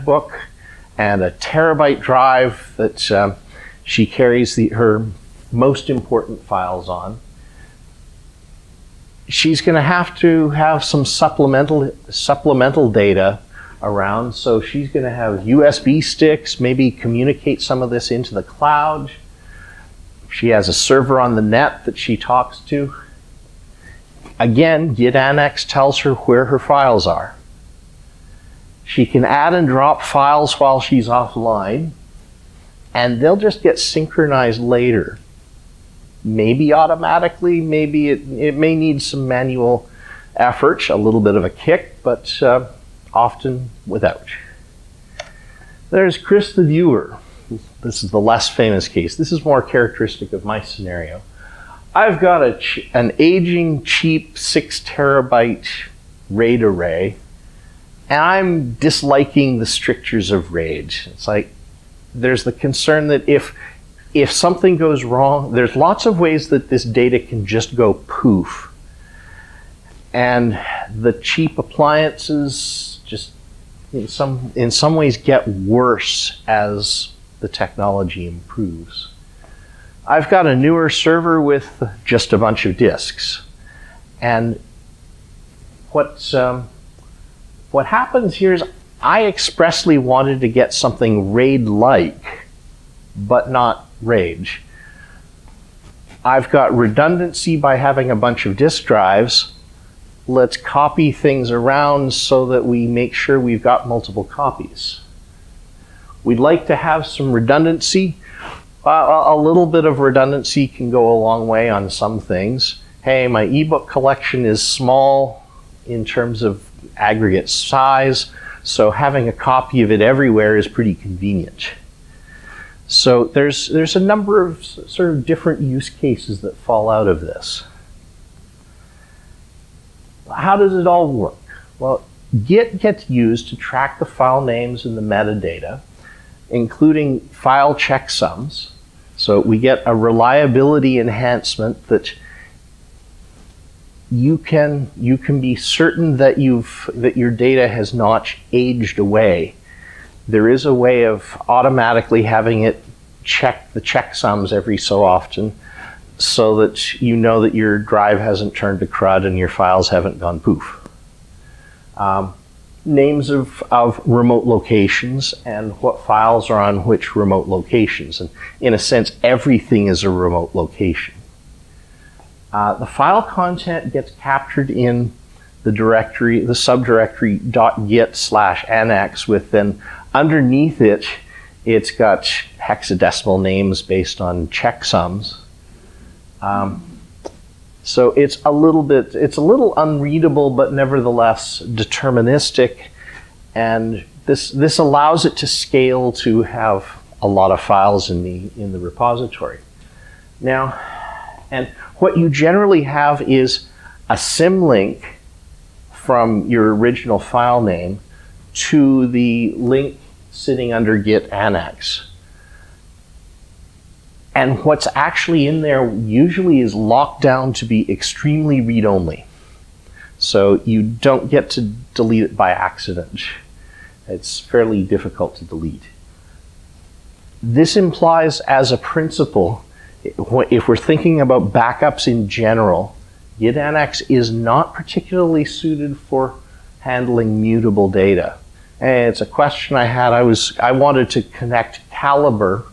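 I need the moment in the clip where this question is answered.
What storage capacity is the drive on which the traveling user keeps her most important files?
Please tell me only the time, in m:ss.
0:01.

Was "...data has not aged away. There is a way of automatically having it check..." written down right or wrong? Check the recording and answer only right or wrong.
right.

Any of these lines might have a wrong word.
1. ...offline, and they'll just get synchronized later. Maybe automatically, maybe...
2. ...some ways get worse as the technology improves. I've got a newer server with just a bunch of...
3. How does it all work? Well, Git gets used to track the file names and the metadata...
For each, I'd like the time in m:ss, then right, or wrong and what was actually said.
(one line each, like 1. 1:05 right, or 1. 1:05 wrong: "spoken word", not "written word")
1. 0:31 right
2. 1:14 right
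3. 2:10 right.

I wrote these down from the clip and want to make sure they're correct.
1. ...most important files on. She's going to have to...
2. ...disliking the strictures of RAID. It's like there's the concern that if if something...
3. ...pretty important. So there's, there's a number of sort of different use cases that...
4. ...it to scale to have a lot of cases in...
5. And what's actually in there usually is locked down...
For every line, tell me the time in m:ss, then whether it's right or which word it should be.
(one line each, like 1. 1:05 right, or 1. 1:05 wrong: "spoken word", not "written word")
1. 0:05 right
2. 0:58 right
3. 2:00 wrong: "convenient", not "important"
4. 3:15 wrong: "files", not "cases"
5. 3:34 right.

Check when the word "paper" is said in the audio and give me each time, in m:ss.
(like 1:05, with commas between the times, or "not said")
not said.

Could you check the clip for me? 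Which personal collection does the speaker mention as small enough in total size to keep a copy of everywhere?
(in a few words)
ebook collection.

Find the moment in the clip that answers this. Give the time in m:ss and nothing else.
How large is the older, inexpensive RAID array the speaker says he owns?
0:54.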